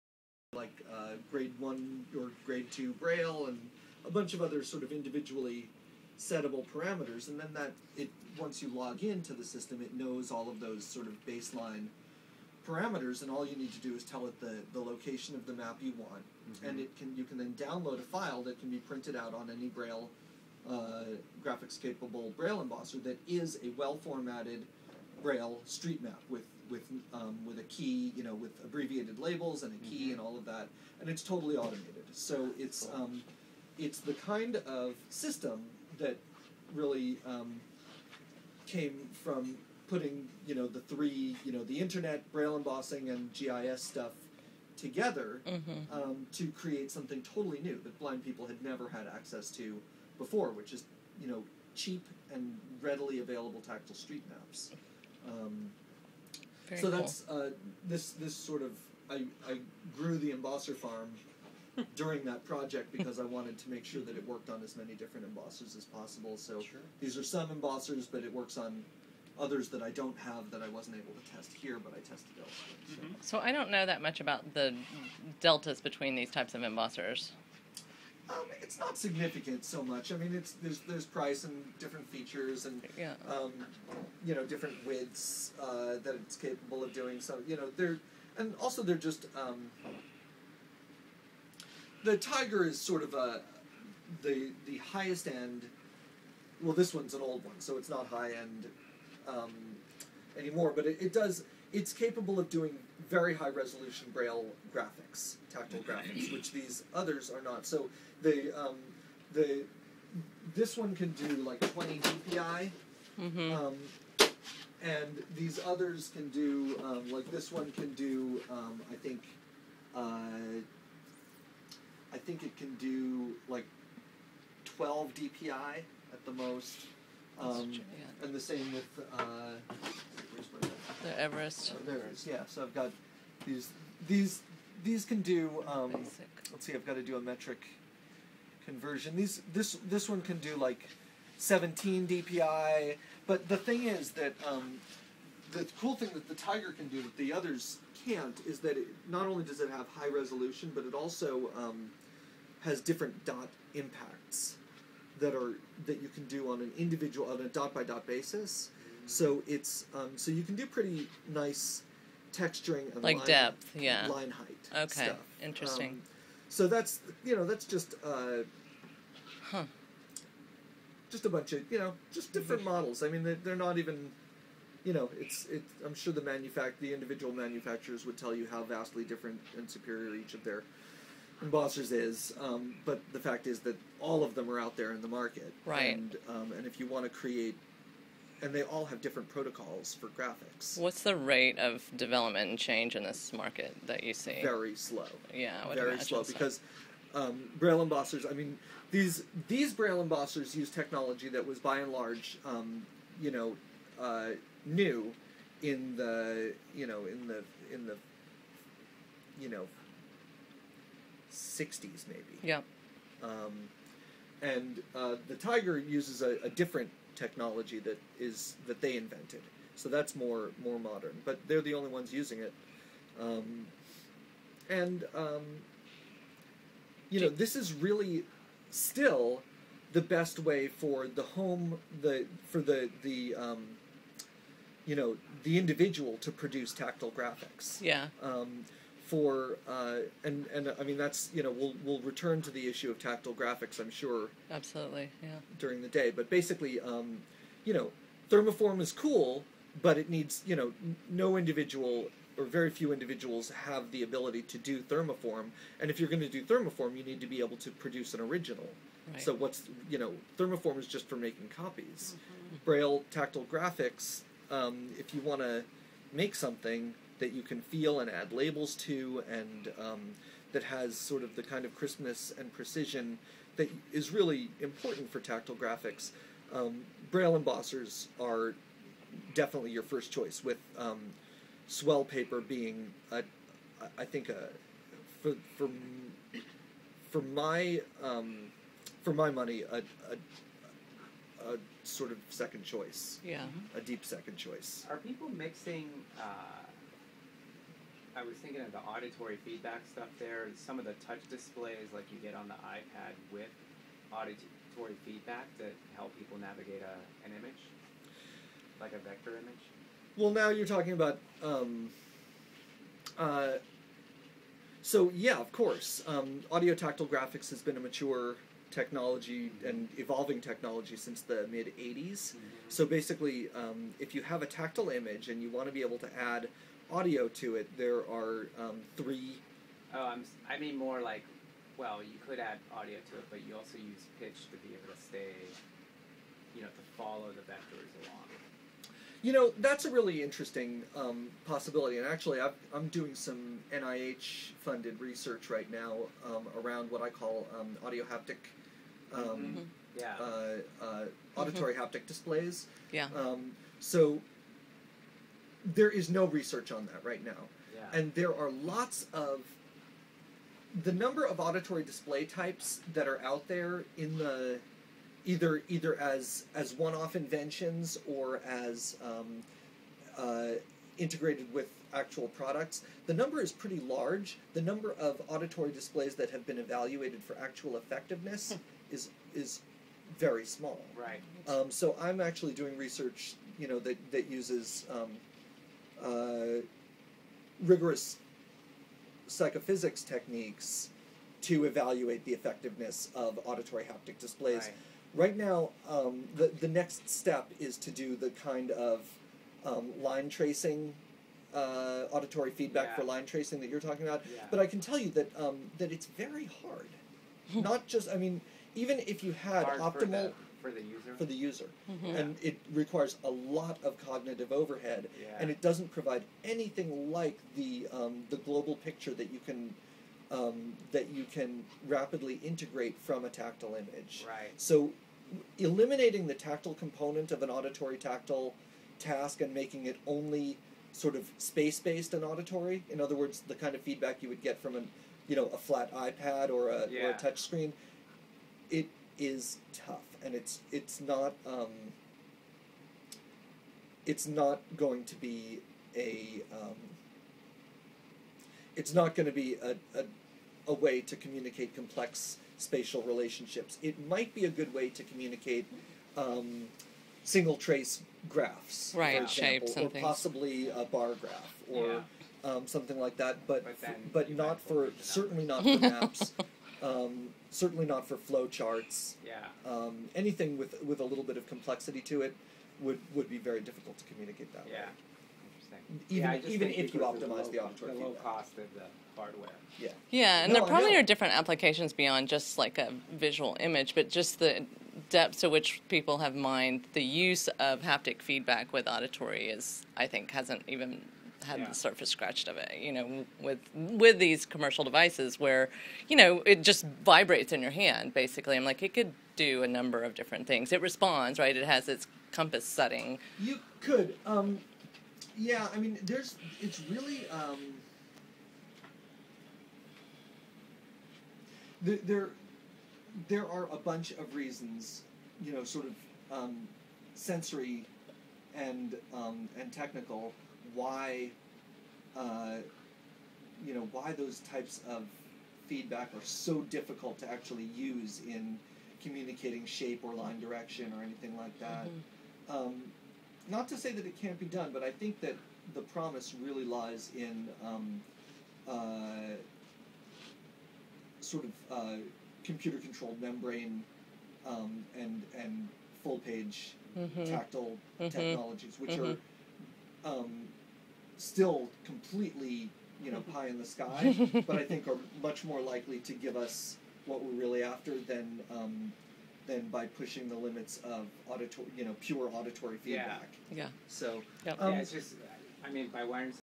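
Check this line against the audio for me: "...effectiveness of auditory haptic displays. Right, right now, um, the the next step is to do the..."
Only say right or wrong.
right.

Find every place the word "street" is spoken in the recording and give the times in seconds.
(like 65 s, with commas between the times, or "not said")
25 s, 53 s.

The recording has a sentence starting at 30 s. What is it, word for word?
and all of that, and it's totally automated.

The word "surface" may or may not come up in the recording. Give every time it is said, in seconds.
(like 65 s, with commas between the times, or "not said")
491 s.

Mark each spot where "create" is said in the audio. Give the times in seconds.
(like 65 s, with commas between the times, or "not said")
46 s, 187 s.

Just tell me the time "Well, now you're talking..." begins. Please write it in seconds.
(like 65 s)
310 s.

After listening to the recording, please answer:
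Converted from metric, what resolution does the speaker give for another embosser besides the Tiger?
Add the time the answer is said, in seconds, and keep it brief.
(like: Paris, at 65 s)
17 DPI, at 141 s.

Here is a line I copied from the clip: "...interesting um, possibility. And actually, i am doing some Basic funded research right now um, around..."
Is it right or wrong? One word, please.
wrong.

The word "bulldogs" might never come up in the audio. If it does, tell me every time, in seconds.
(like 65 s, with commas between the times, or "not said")
not said.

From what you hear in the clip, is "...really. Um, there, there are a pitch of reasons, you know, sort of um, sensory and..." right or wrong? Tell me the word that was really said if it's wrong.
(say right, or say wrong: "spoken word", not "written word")
wrong: "bunch", not "pitch".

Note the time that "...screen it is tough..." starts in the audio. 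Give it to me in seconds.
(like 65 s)
437 s.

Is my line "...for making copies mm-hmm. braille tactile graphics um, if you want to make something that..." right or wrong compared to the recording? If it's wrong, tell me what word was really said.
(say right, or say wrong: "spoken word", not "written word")
right.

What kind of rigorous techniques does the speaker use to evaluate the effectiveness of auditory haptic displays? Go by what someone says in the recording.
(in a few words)
psychophysics.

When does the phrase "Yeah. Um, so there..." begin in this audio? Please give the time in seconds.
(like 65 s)
352 s.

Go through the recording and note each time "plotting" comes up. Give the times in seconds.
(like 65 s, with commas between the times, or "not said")
not said.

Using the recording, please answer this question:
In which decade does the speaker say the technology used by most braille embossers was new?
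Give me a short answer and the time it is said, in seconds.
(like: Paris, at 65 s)
1960s, at 211 s.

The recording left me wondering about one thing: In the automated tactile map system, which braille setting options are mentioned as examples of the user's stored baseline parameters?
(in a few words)
grade one or grade two.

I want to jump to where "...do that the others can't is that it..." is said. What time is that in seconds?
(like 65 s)
146 s.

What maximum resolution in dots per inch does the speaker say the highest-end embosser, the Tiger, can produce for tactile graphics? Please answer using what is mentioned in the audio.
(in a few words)
20 dpi.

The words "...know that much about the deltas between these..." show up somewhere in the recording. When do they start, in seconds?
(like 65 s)
73 s.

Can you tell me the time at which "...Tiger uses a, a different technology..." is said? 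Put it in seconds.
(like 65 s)
215 s.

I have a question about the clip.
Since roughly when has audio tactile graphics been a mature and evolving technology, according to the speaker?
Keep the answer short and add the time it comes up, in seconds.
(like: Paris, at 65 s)
mid 80s, at 321 s.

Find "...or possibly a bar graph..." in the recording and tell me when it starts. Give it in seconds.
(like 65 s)
459 s.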